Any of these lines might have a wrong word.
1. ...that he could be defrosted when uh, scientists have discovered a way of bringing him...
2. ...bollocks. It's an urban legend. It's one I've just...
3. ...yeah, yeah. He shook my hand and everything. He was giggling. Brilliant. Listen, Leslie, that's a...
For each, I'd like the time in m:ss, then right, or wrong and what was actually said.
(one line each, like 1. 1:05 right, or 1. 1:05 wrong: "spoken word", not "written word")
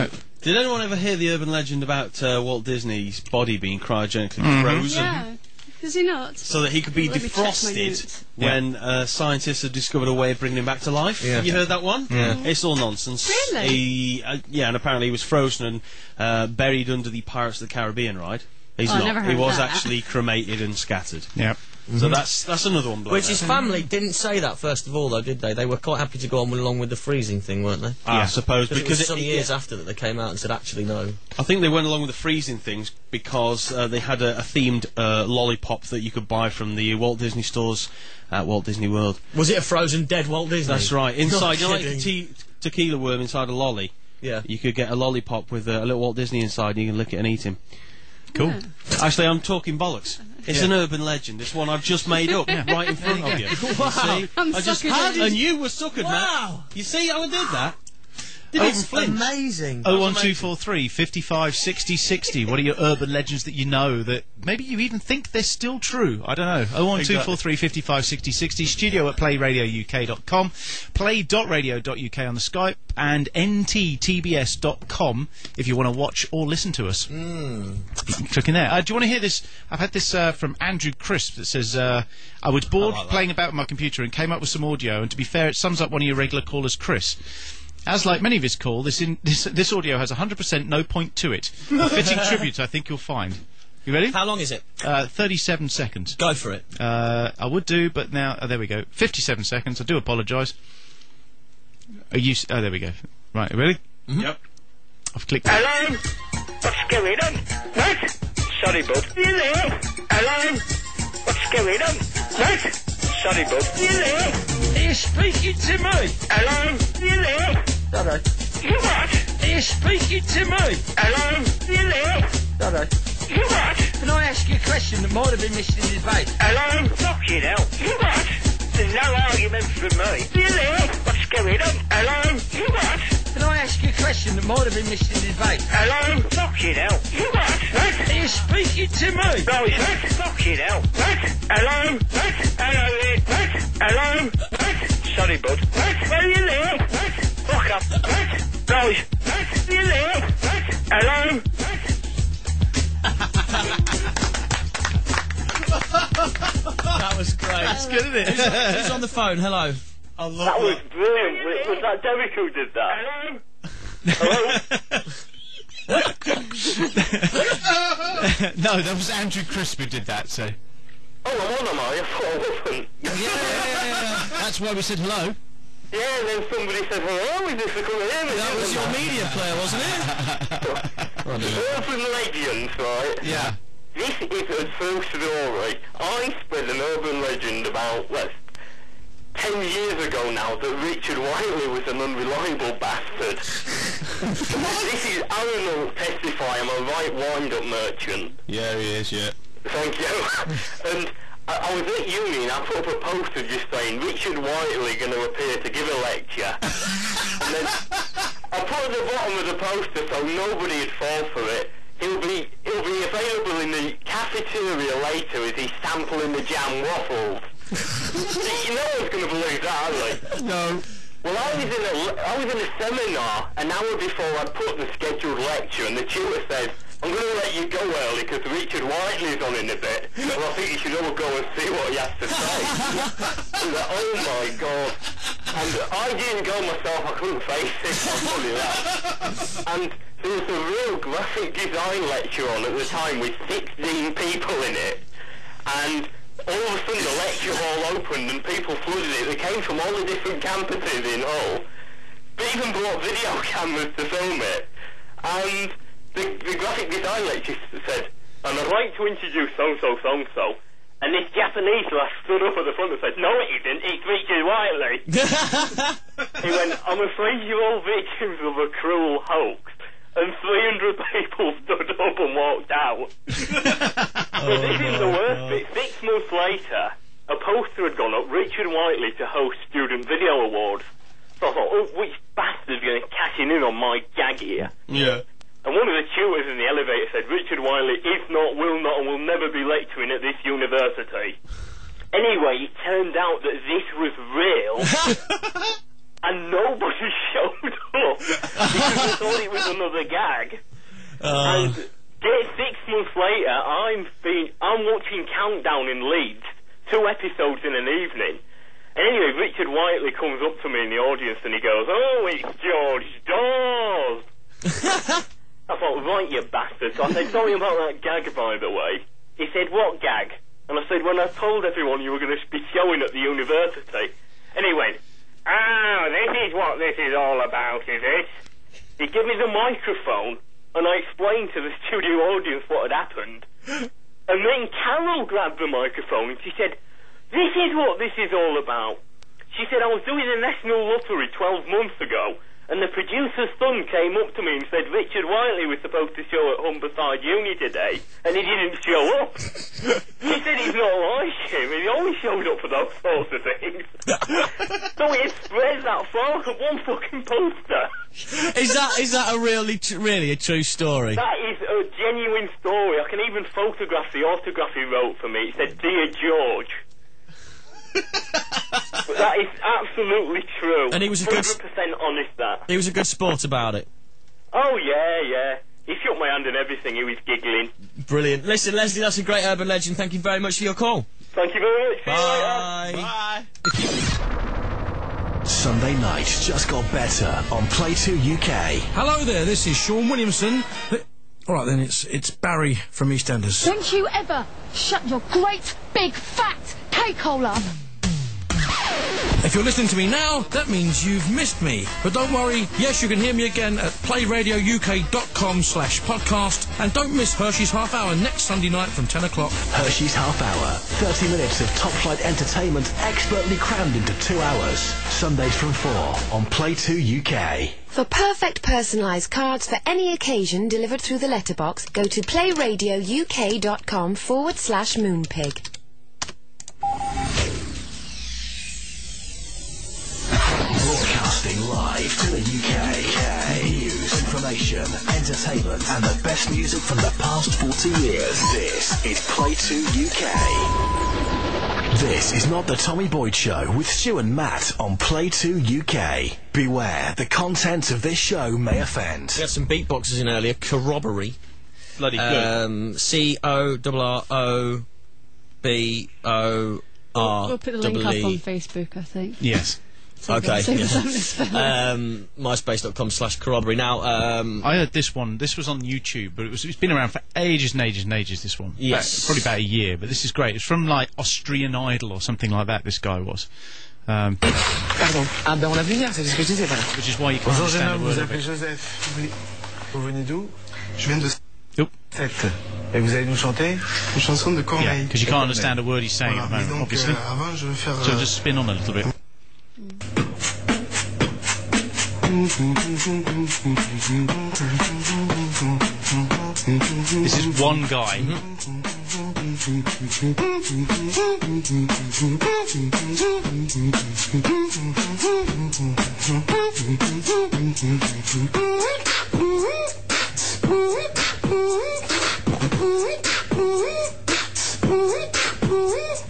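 1. 0:06 right
2. 0:49 right
3. 6:14 right.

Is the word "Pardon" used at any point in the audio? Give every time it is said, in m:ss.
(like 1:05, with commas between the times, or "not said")
7:54.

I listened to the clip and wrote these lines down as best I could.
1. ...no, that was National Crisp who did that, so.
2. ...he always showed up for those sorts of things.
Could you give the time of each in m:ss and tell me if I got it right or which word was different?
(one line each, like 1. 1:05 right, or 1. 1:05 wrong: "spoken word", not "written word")
1. 2:48 wrong: "Andrew", not "National"
2. 5:51 right.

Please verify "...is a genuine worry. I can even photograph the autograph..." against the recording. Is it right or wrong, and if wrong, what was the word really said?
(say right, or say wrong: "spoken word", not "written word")
wrong: "story", not "worry".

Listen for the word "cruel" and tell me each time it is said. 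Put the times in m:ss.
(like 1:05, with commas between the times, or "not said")
4:28.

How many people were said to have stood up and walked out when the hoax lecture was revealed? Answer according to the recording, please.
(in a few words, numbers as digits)
300.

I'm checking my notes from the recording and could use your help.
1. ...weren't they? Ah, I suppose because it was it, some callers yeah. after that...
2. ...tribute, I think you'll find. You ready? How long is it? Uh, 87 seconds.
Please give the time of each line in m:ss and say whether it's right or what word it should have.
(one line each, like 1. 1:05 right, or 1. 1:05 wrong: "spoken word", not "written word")
1. 0:27 wrong: "years", not "callers"
2. 1:32 wrong: "37", not "87".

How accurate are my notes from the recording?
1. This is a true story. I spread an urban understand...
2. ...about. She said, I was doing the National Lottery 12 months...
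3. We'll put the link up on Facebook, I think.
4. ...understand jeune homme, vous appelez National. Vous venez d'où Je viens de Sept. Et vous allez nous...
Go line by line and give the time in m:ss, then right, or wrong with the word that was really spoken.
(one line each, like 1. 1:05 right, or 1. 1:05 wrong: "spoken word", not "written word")
1. 3:03 wrong: "legend", not "understand"
2. 5:38 right
3. 7:37 right
4. 7:57 wrong: "Joseph", not "National".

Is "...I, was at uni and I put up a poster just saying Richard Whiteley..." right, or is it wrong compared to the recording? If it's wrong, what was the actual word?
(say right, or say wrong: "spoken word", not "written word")
right.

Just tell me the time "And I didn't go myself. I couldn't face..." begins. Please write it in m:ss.
3:55.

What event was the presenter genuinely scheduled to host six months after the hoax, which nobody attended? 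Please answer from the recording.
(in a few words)
Student Video Awards.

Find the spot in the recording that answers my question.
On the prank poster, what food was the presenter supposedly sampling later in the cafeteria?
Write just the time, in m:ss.
3:36.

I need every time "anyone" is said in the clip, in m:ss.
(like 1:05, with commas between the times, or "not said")
0:00.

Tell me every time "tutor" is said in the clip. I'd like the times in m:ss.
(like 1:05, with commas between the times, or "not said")
3:46, 4:46.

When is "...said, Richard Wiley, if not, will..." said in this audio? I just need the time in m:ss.
4:47.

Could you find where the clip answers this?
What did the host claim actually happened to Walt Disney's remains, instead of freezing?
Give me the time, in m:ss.
0:20.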